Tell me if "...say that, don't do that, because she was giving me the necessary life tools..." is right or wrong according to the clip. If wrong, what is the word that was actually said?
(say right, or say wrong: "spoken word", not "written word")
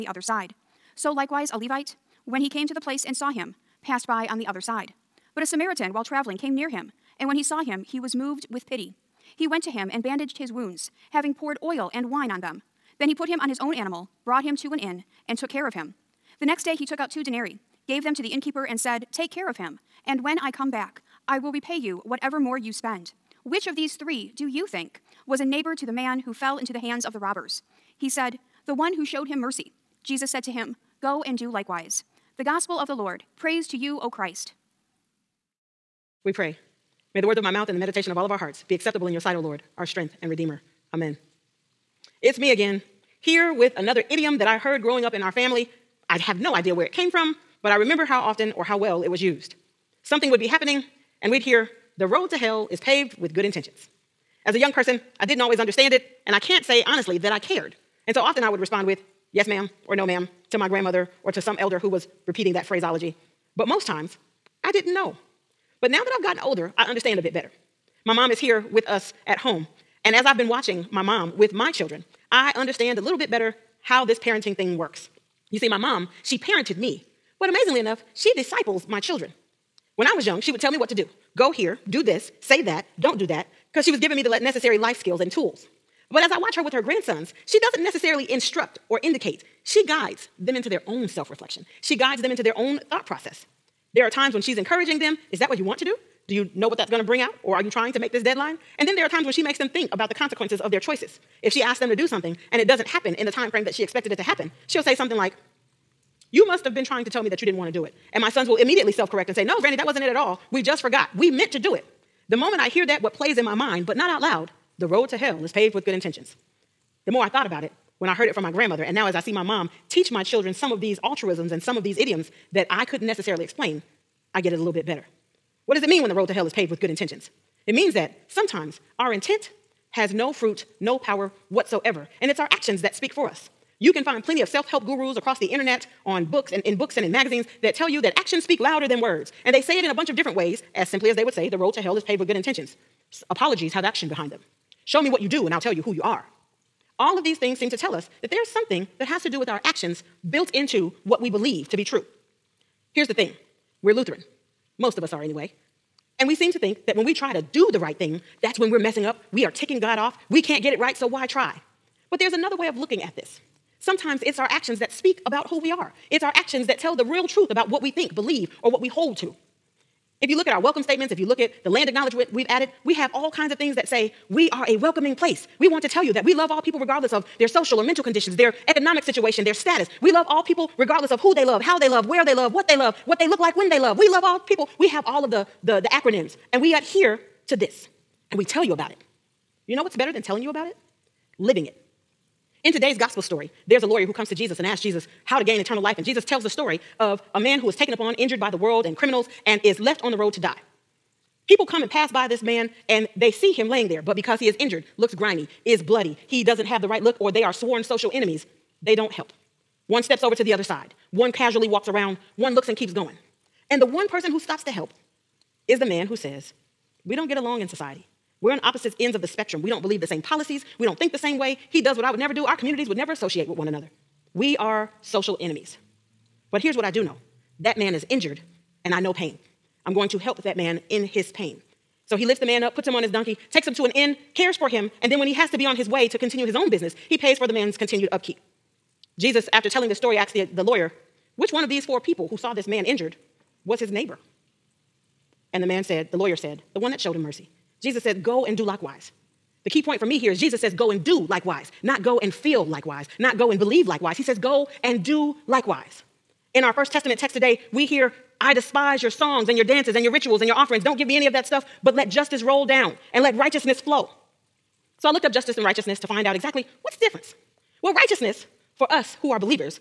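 wrong: "skills", not "tools".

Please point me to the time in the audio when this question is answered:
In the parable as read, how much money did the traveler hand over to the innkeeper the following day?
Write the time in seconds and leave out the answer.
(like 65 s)
17 s.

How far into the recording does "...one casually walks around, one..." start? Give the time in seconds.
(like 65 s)
211 s.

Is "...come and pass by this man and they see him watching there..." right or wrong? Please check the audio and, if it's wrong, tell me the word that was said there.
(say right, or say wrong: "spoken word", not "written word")
wrong: "laying", not "watching".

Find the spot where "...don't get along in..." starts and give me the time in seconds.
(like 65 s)
217 s.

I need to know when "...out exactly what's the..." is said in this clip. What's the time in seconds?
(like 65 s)
266 s.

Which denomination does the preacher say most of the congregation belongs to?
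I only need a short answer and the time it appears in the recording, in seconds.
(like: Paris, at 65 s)
Lutheran, at 153 s.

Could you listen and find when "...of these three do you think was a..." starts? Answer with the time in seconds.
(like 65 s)
23 s.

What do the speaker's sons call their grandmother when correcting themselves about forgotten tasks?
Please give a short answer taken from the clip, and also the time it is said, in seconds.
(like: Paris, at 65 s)
Granny, at 109 s.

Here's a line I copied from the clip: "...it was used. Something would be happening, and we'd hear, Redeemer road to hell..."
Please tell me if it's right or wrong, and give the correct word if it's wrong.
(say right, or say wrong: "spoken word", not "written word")
wrong: "The", not "Redeemer".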